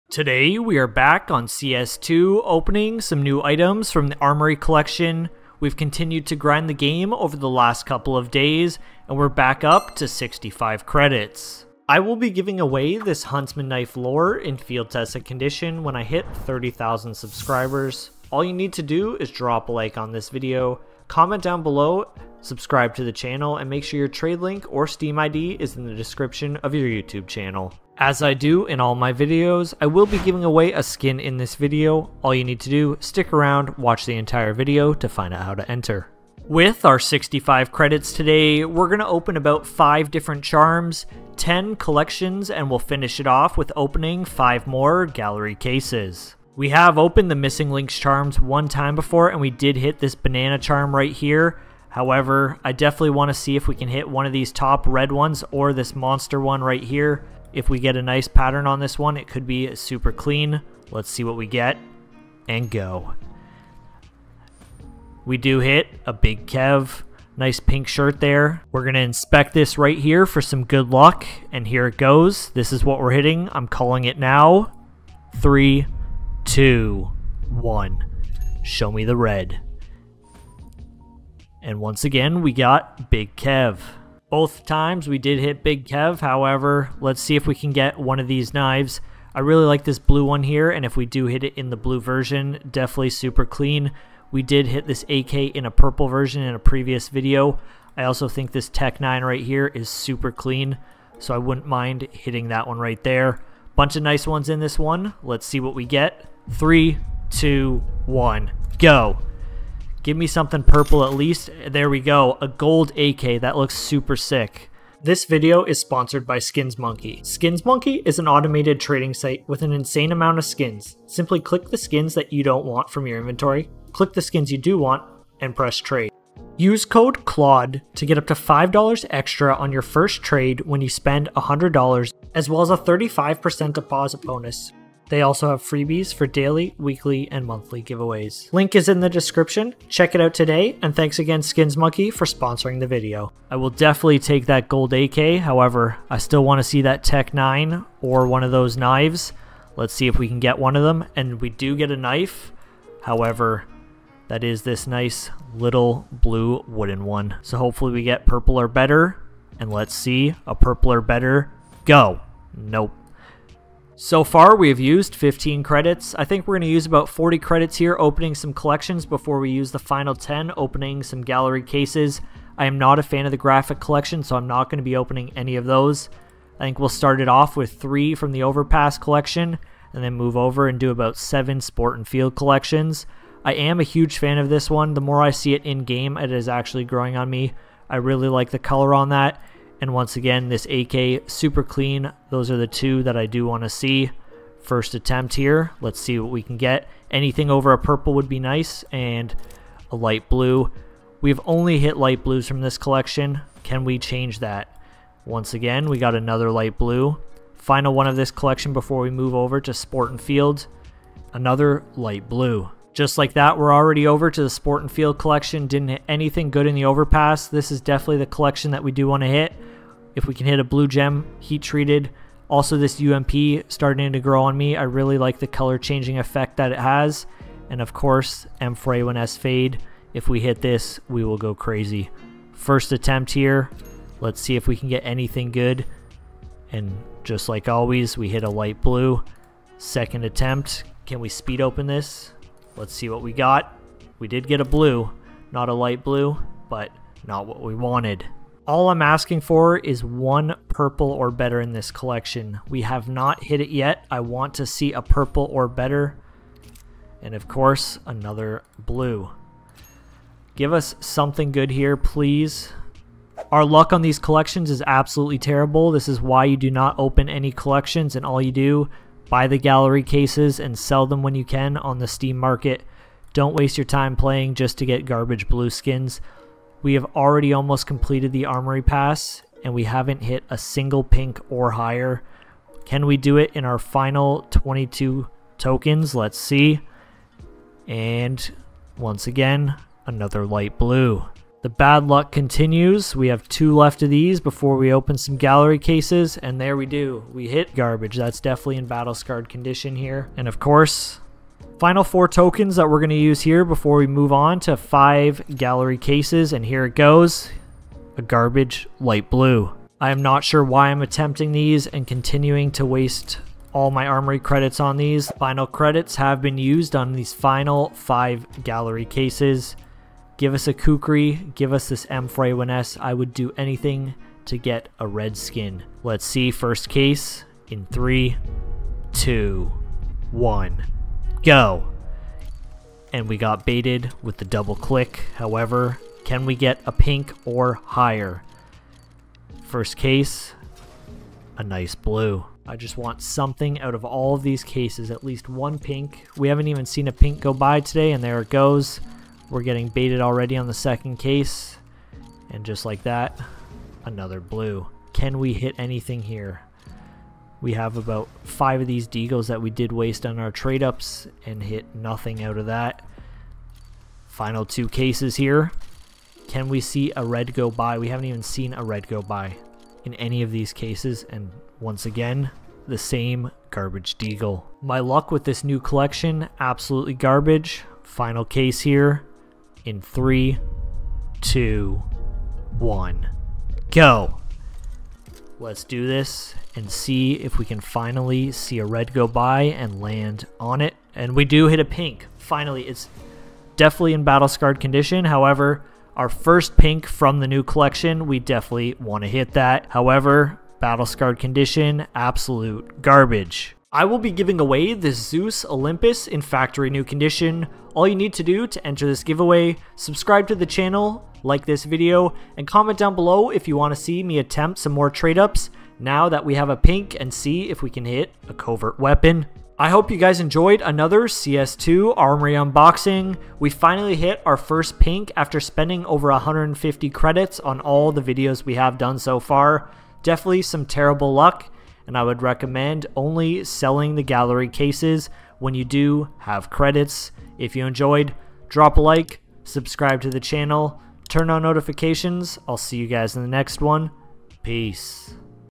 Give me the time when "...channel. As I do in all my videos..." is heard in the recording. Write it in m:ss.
0:27.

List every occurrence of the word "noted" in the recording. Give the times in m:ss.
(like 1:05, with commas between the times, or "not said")
not said.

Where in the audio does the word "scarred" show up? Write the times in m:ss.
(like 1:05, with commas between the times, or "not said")
4:59, 6:34, 6:41.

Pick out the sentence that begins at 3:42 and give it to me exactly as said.
Also, this UMP starting to grow on me.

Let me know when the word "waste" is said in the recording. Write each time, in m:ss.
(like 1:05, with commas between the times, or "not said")
4:33, 5:12, 5:59.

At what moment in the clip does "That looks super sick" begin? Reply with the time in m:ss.
1:53.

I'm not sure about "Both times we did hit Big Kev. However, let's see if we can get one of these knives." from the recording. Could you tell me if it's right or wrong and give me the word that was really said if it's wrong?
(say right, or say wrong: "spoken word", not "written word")
right.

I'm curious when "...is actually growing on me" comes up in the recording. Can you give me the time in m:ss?
3:06.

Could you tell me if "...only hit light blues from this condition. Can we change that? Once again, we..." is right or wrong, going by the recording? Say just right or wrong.
wrong.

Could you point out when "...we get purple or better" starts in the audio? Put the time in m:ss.
2:37.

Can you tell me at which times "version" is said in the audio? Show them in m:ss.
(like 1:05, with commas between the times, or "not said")
1:31, 1:36.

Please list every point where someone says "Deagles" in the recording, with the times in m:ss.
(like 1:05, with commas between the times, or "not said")
5:59, 6:14.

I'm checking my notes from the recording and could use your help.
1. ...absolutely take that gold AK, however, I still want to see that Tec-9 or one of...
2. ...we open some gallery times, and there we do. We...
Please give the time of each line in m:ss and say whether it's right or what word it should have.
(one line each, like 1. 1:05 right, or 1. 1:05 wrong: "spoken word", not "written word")
1. 2:23 wrong: "definitely", not "absolutely"
2. 4:54 wrong: "cases", not "times".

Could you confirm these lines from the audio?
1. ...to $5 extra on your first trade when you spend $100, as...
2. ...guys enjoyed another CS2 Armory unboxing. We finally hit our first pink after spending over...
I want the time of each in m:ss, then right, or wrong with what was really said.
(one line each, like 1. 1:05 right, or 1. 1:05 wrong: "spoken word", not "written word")
1. 2:08 right
2. 7:00 right.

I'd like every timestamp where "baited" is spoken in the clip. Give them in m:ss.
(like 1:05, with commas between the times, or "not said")
5:33, 5:49.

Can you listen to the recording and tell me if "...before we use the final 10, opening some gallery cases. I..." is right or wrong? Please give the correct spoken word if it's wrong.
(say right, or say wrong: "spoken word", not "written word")
right.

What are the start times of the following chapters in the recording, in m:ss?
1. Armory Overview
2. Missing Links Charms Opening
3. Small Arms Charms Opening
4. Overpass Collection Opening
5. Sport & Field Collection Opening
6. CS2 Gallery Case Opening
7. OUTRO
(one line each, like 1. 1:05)
1. 0:36
2. 0:46
3. 1:19
4. 2:57
5. 3:33
6. 5:12
7. 7:04.